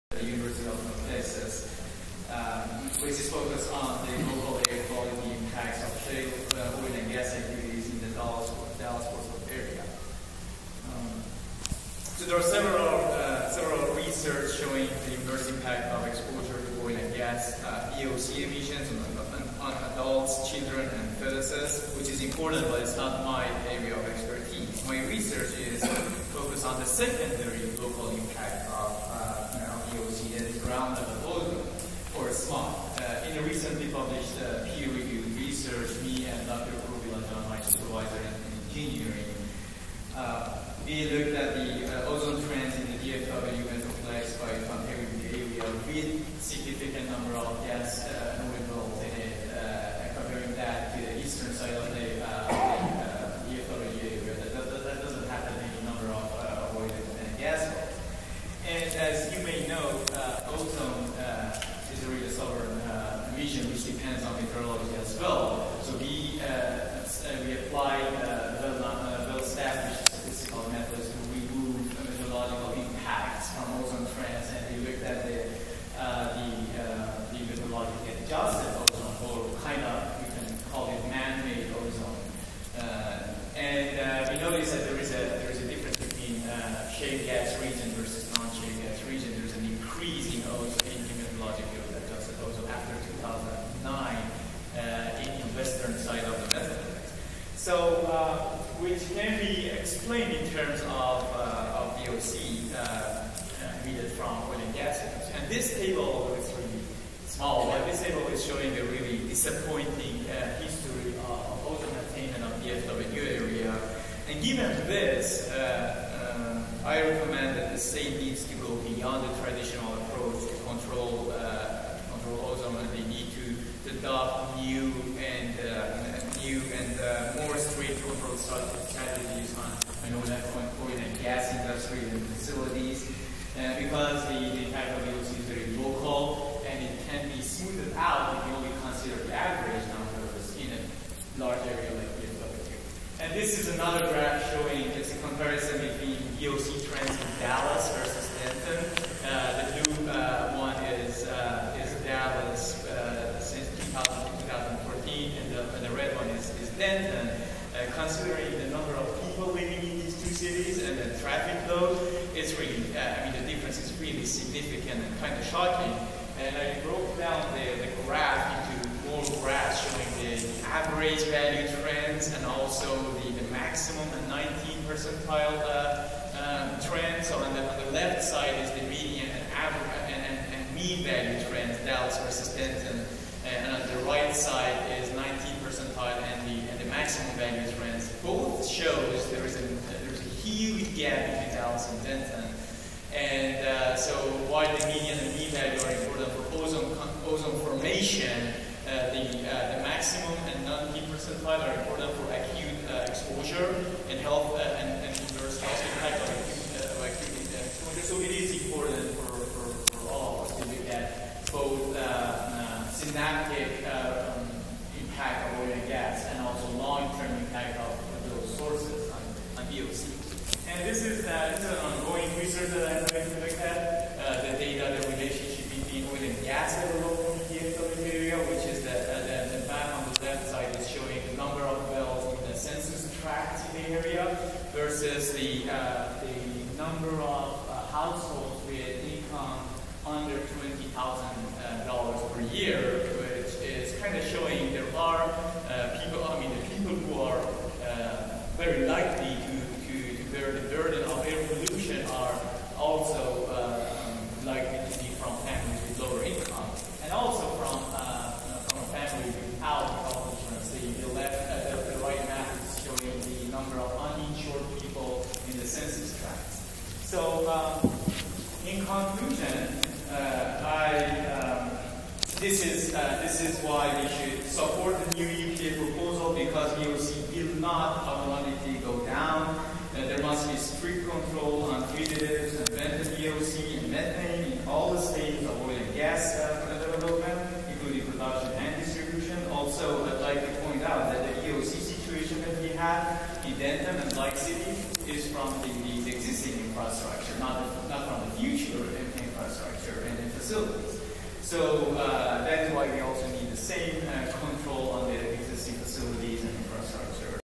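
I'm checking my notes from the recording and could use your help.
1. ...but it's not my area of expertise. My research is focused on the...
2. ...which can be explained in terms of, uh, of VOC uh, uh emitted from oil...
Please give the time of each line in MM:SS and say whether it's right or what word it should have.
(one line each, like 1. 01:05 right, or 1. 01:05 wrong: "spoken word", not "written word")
1. 00:22 right
2. 01:38 right.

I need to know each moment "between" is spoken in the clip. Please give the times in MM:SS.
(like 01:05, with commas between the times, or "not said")
03:11, 03:45.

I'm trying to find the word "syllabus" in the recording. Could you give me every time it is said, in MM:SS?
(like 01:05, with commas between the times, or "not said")
not said.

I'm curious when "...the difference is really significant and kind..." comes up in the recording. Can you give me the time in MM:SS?
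02:43.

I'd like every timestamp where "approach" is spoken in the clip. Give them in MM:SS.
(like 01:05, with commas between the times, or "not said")
02:00.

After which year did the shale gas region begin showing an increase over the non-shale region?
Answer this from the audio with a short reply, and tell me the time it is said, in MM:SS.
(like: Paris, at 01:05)
2009, at 01:33.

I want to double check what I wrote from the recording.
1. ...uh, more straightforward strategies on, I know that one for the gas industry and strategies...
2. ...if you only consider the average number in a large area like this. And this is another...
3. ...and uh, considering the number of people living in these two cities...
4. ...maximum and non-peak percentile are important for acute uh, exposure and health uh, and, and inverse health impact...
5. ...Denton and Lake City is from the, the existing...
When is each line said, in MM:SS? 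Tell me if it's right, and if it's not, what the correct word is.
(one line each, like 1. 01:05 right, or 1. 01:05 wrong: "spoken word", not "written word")
1. 02:06 wrong: "facilities", not "strategies"
2. 02:18 right
3. 02:36 right
4. 03:19 right
5. 04:53 right.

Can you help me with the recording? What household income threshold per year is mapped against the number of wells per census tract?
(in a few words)
$20,000.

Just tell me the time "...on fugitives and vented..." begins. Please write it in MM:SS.
04:41.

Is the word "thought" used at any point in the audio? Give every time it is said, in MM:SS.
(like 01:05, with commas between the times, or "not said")
not said.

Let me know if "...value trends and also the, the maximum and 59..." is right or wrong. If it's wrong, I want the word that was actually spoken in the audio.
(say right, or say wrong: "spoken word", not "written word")
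wrong: "19", not "59".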